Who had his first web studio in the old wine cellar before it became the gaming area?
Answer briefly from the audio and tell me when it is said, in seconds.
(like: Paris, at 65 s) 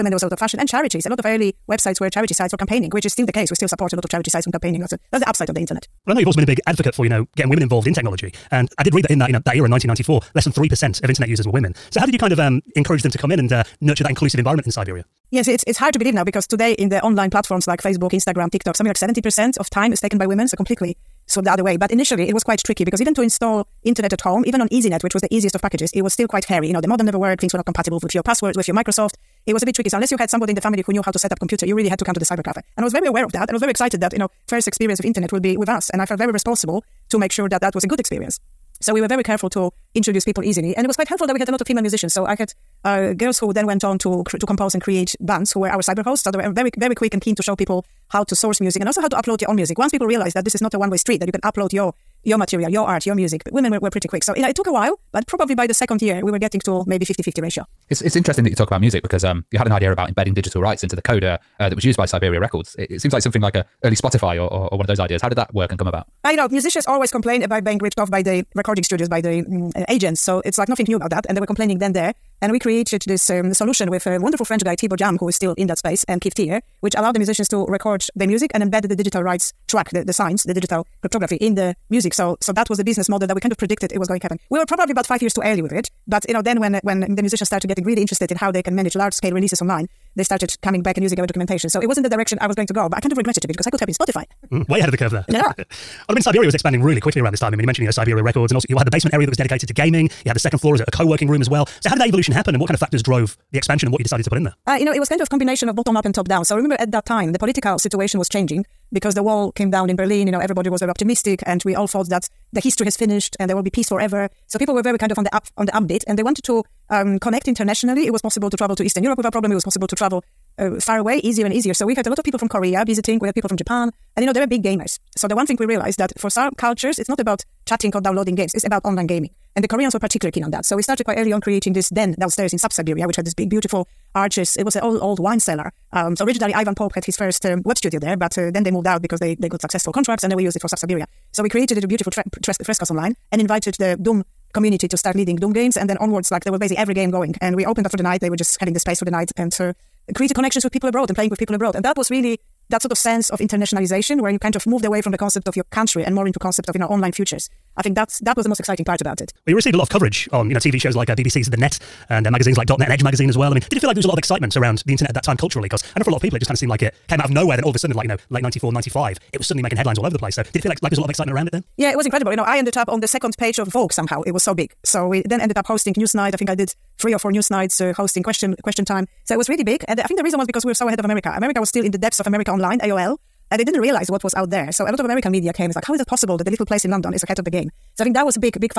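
Ivan Pope, at 136 s.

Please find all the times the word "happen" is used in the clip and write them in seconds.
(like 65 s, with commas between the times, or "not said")
84 s, 102 s.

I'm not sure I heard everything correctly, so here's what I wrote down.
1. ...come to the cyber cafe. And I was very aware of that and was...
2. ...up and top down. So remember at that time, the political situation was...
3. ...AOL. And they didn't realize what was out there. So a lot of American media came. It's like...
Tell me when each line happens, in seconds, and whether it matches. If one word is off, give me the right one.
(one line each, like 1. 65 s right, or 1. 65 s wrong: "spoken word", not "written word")
1. 32 s right
2. 105 s right
3. 182 s right.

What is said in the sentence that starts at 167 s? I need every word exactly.
Then all of a sudden, like, you know, late 94, 95, it was suddenly making headlines all over the place.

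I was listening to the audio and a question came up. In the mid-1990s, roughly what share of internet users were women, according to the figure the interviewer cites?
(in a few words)
less than 3%.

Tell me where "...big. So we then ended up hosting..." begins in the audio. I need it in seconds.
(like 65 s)
174 s.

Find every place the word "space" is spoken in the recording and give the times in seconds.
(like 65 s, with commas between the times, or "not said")
75 s, 148 s.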